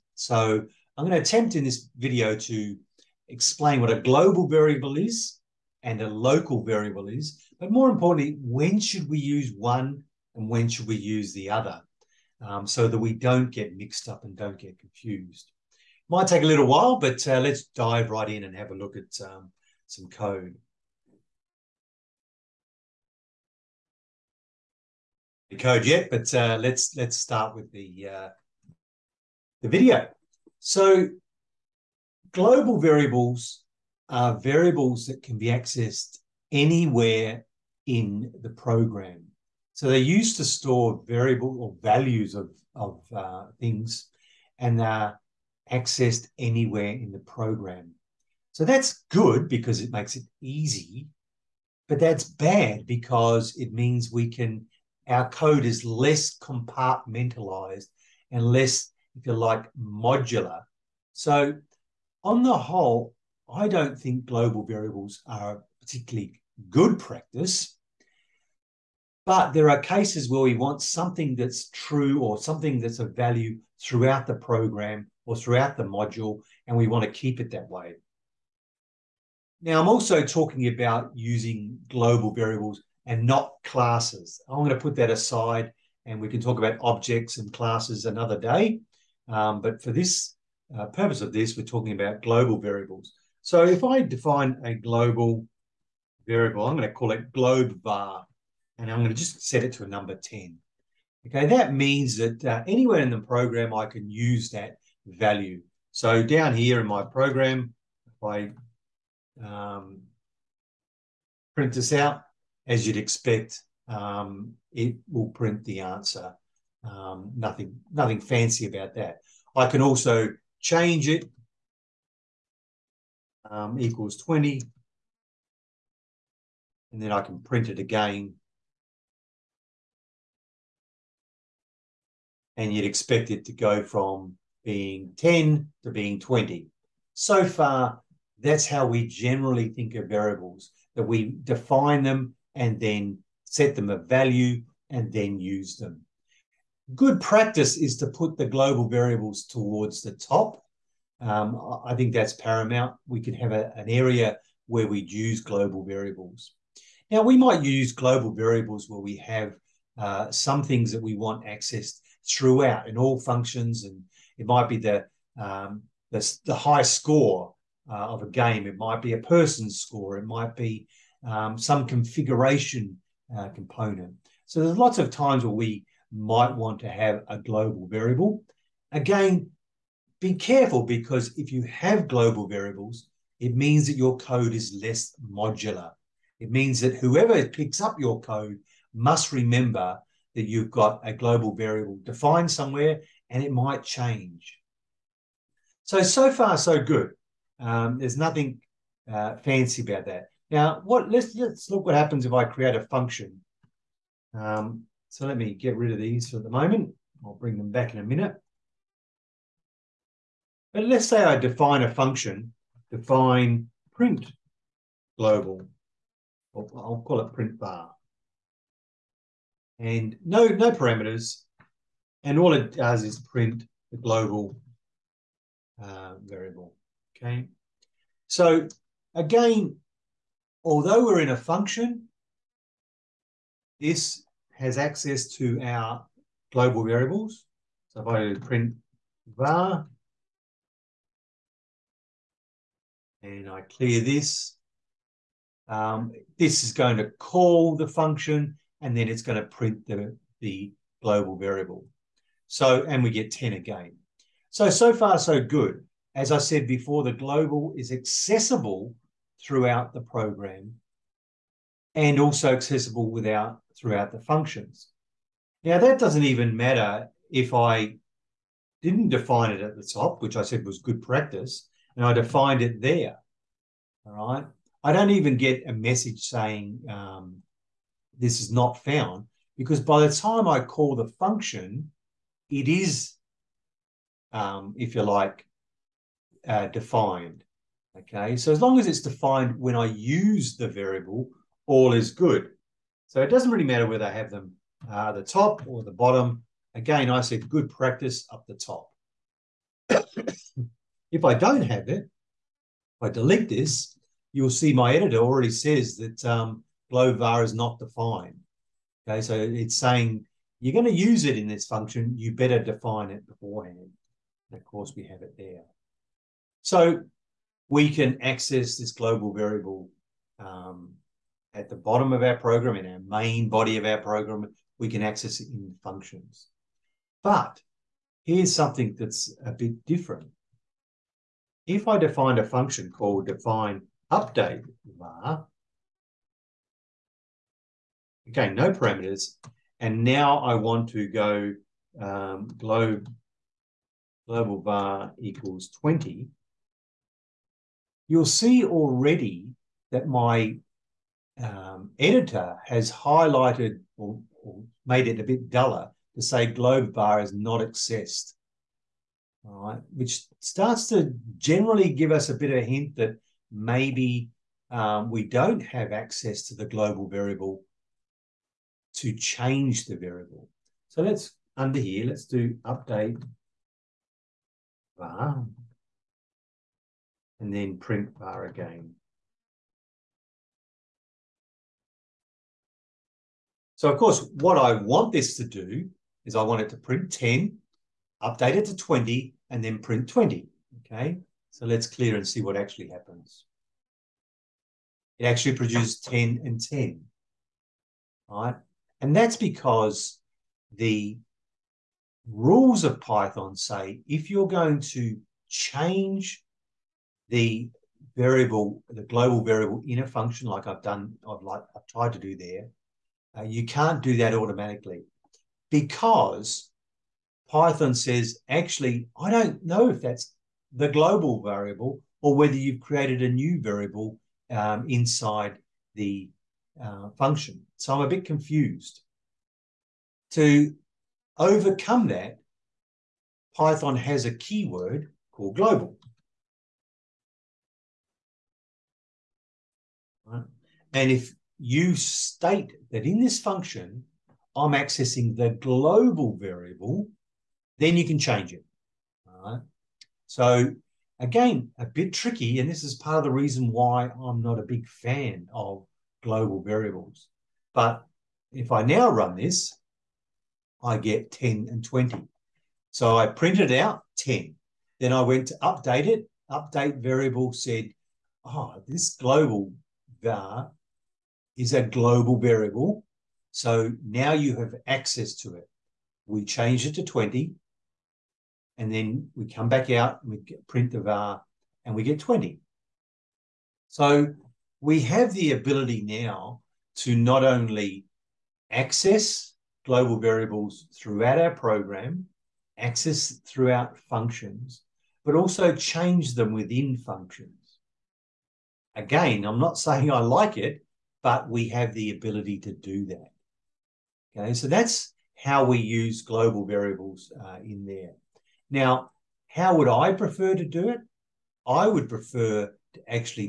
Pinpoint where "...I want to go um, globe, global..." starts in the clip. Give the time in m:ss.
5:40.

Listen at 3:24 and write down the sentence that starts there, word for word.
Um, so let me get rid of these for the moment.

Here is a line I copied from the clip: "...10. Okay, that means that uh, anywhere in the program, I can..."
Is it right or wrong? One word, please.
right.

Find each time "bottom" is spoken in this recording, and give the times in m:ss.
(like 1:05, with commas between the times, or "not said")
4:55, 5:21.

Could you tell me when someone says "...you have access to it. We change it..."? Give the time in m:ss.
7:54.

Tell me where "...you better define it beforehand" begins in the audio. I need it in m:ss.
5:12.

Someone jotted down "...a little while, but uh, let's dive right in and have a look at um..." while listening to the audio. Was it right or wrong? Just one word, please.
right.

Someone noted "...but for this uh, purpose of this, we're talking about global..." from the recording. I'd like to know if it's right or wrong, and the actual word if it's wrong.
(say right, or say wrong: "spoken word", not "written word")
right.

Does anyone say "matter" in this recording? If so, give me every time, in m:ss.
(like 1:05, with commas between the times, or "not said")
4:26, 4:53.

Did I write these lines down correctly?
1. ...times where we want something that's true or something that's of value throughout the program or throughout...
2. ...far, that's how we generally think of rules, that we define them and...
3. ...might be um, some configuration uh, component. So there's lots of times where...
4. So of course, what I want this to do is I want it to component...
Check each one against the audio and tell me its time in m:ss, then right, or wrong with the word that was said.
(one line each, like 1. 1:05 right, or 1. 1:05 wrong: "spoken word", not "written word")
1. 1:09 wrong: "cases", not "times"
2. 2:17 wrong: "variables", not "rules"
3. 2:50 right
4. 6:23 wrong: "print", not "component".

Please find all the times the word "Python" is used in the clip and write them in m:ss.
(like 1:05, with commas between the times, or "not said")
6:43, 6:57, 7:13.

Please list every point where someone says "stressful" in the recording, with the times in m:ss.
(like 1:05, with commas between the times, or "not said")
not said.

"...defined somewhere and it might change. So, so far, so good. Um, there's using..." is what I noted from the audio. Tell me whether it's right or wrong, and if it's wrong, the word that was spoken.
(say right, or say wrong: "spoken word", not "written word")
wrong: "nothing", not "using".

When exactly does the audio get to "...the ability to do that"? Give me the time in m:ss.
8:21.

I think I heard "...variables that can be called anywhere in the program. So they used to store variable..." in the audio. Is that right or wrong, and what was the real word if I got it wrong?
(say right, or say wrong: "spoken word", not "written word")
wrong: "accessed", not "called".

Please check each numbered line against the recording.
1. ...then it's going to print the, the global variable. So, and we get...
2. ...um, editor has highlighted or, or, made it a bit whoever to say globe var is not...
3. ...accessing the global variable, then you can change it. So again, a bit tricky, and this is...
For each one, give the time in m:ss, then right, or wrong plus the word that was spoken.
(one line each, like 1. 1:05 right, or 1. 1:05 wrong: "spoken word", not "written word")
1. 4:08 right
2. 5:51 wrong: "duller", not "whoever"
3. 7:24 right.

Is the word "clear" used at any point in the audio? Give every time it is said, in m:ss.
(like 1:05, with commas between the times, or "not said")
4:03, 6:31.